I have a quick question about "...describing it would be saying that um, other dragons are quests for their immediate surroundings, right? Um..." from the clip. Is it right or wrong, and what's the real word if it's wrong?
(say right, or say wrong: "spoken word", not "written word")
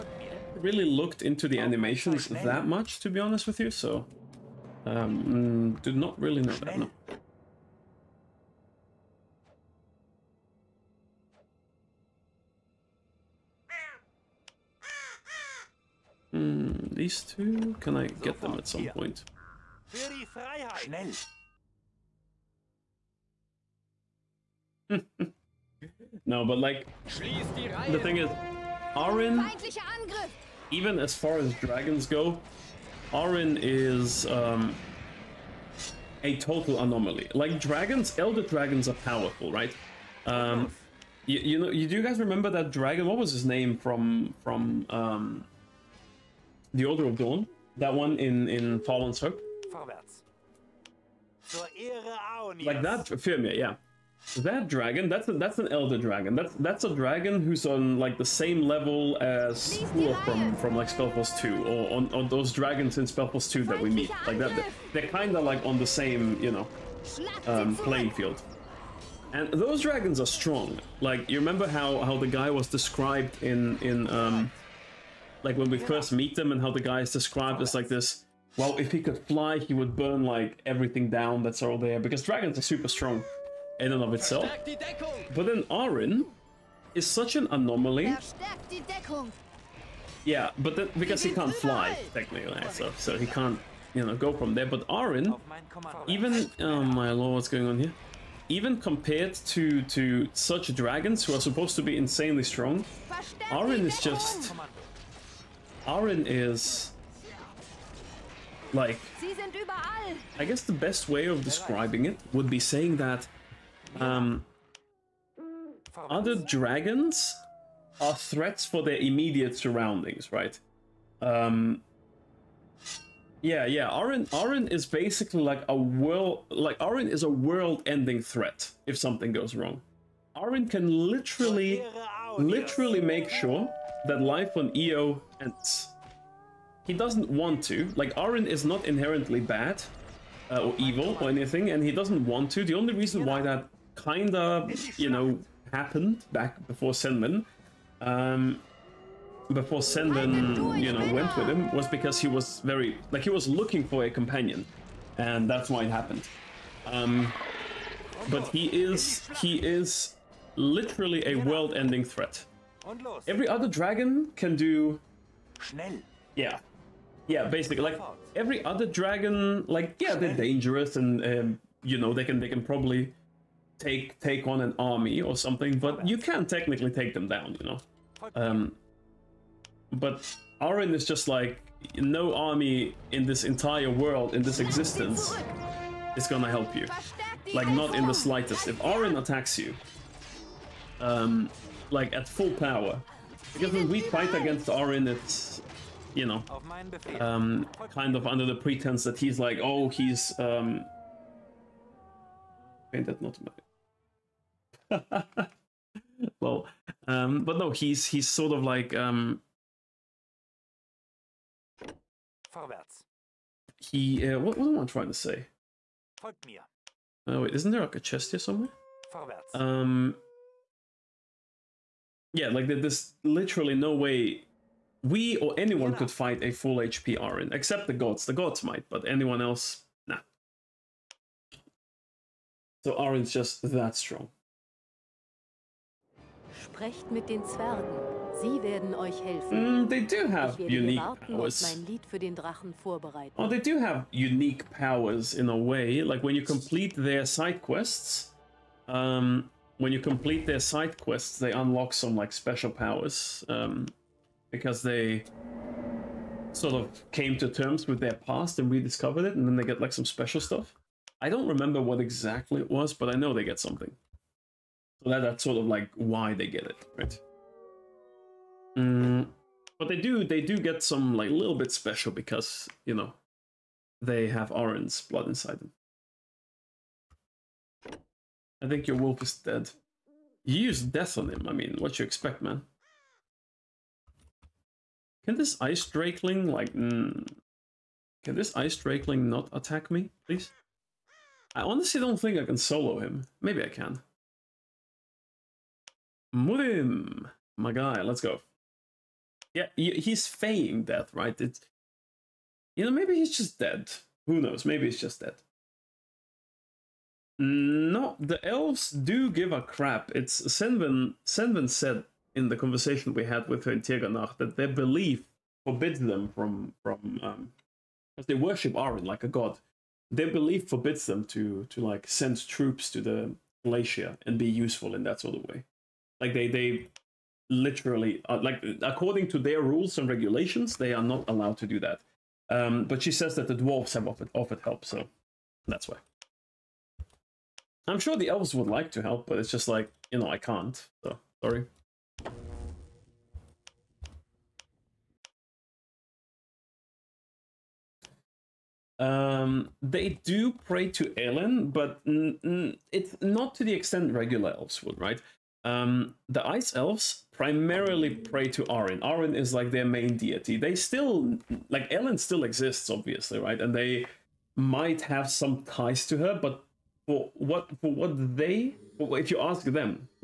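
wrong: "threats", not "quests".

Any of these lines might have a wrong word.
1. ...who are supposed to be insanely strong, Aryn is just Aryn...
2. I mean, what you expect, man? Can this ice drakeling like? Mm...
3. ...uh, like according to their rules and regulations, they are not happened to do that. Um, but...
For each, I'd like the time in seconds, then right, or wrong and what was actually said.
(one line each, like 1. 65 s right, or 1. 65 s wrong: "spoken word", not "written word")
1. 101 s right
2. 281 s right
3. 328 s wrong: "allowed", not "happened".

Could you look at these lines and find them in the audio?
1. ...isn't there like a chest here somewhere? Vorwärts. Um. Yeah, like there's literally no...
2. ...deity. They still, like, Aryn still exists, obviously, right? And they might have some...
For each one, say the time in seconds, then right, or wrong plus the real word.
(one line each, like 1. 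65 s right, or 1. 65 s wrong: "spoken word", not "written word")
1. 217 s right
2. 360 s wrong: "Elen", not "Aryn".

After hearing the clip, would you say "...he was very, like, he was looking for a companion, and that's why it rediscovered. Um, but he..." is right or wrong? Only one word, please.
wrong.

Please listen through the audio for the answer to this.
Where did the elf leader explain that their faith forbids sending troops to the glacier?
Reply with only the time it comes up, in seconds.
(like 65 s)
313 s.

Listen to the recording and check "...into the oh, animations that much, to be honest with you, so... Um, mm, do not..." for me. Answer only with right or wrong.
right.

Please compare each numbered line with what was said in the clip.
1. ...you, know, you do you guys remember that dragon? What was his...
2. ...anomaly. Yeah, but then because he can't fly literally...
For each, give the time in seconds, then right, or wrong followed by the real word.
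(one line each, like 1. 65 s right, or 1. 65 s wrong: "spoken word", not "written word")
1. 41 s right
2. 87 s wrong: "technically", not "literally".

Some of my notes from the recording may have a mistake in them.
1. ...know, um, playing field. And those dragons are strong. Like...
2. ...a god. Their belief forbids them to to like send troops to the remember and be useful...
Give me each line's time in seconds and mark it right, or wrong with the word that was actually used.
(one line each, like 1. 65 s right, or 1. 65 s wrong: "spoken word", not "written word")
1. 66 s right
2. 319 s wrong: "glacier", not "remember".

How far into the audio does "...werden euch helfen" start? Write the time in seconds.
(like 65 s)
238 s.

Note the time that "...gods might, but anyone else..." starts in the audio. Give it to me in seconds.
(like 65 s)
228 s.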